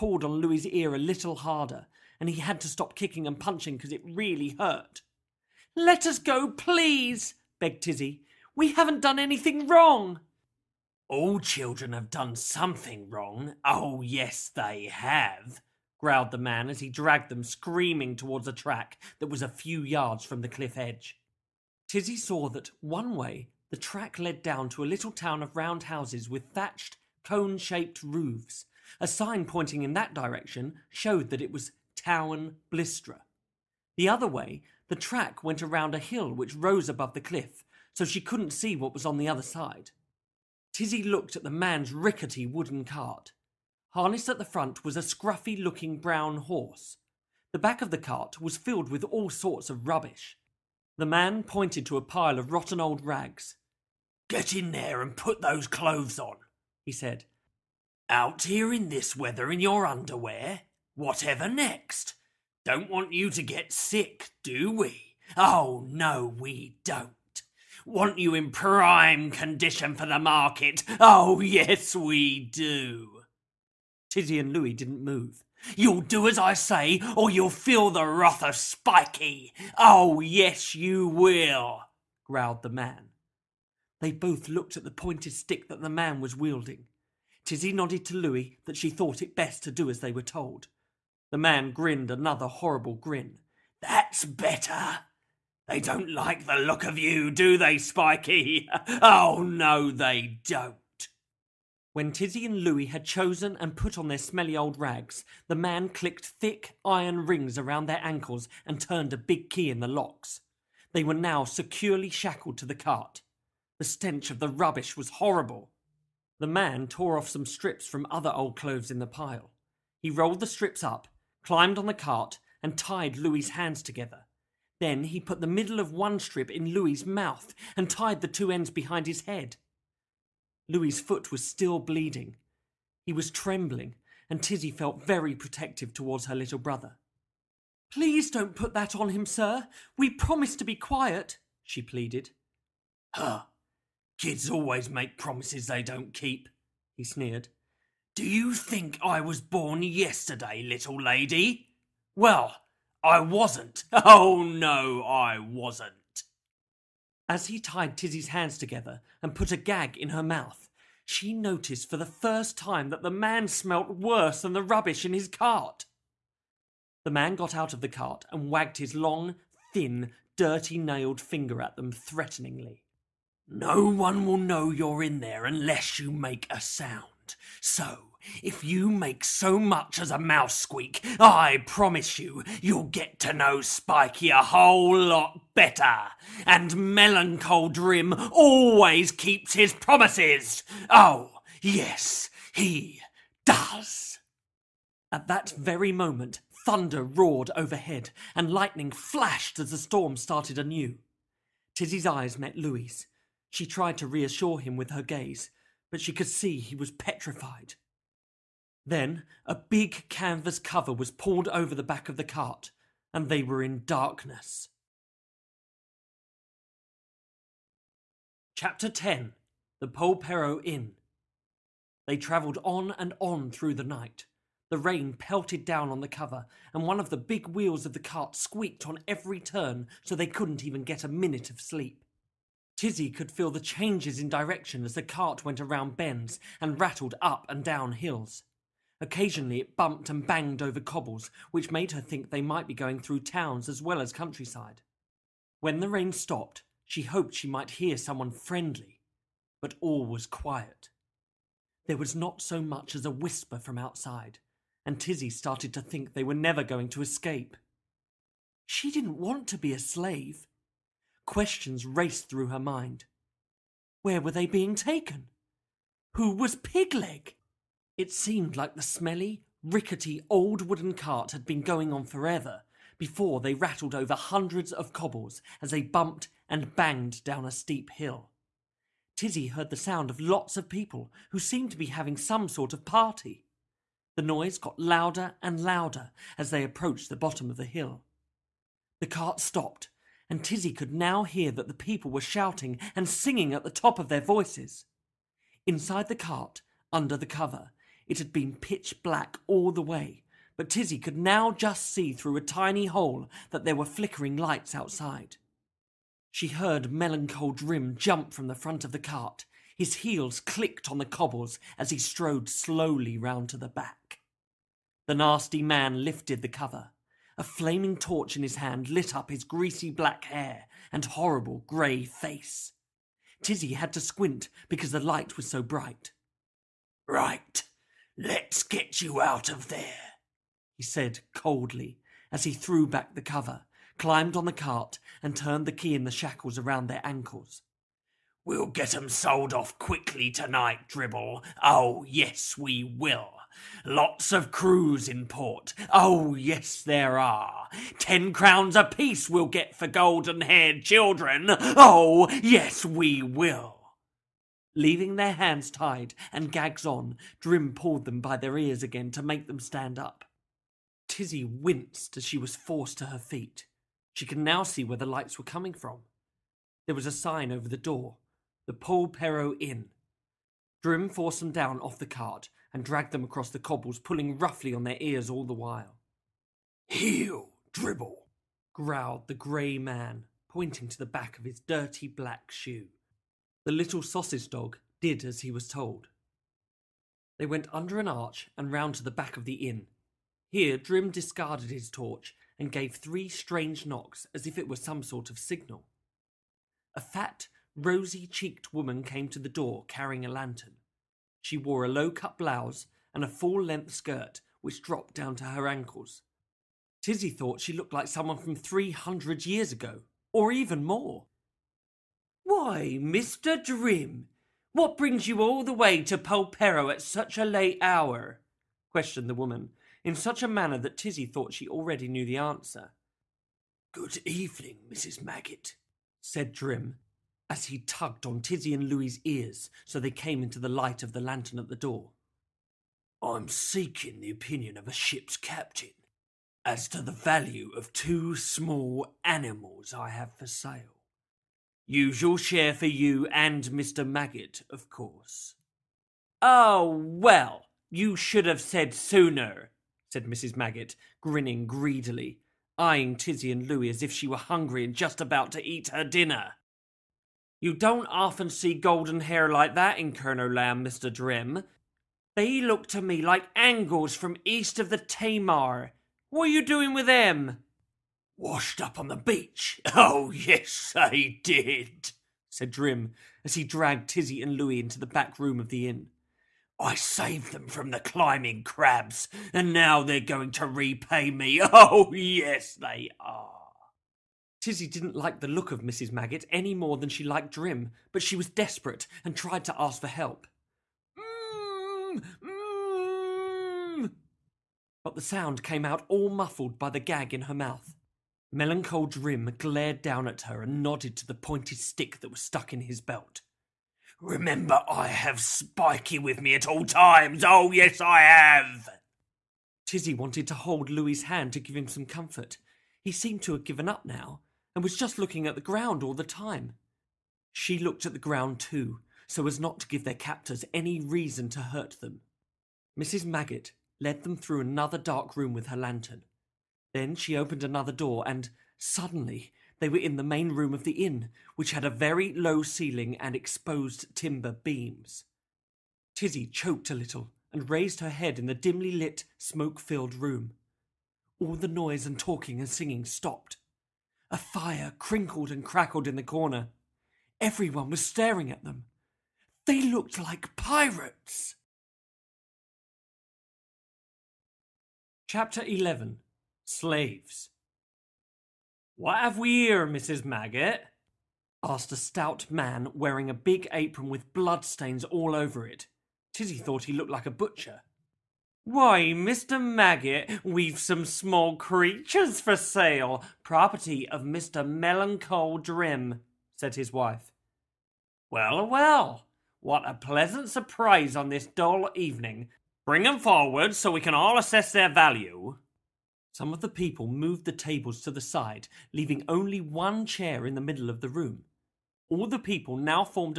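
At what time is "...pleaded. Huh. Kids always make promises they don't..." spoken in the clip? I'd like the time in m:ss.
2:21.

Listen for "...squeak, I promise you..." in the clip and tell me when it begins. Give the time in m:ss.
3:00.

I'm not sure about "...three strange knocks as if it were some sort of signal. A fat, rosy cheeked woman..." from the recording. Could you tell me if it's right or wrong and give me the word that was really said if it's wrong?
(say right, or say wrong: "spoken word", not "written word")
right.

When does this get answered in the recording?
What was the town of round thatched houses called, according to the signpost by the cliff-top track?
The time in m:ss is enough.
0:31.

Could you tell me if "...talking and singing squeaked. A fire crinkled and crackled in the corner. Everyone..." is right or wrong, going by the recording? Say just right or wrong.
wrong.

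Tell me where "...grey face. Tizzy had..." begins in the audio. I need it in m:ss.
5:21.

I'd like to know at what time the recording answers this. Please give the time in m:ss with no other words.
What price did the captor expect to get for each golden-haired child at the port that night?
5:47.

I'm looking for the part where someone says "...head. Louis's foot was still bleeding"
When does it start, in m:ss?
2:09.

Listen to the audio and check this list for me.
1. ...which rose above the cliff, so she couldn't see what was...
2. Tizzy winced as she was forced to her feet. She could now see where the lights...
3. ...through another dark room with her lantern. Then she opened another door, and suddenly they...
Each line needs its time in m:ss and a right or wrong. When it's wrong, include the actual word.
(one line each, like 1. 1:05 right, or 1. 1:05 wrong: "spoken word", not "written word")
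1. 0:36 right
2. 6:01 right
3. 8:44 right.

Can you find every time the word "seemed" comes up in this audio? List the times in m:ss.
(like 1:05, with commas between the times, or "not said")
4:28, 4:41, 8:33.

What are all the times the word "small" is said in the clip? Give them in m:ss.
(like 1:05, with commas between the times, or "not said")
7:18, 9:31.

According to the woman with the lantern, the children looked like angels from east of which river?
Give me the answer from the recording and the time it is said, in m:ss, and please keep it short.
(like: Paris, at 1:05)
Tamar, at 7:44.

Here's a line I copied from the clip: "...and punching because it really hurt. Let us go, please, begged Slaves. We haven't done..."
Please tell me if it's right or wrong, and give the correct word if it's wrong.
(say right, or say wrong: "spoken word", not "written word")
wrong: "Tizzy", not "Slaves".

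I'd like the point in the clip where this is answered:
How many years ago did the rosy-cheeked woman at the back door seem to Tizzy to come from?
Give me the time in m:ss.
6:48.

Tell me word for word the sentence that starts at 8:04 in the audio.
Tizzy didn't like the look of Mrs.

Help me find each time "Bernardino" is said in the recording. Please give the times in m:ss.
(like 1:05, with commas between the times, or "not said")
not said.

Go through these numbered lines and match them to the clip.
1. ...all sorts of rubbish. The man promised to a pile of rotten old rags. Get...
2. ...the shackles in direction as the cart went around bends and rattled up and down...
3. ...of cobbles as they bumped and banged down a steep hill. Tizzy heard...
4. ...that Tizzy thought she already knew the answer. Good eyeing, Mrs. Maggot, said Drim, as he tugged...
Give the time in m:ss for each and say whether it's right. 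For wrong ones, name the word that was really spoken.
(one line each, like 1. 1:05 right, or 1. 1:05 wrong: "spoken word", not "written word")
1. 0:49 wrong: "pointed", not "promised"
2. 3:53 wrong: "changes", not "shackles"
3. 4:34 right
4. 7:00 wrong: "evening", not "eyeing".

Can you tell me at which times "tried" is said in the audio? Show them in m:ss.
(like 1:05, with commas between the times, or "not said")
3:23, 8:09.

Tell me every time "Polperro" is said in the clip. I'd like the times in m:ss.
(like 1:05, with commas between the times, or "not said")
3:39, 6:08, 6:56.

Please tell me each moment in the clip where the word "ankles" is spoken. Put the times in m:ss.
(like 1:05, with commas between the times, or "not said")
1:48, 5:37, 6:45.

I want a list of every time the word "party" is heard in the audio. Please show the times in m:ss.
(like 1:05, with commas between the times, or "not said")
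4:42.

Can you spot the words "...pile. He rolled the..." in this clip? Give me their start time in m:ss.
1:59.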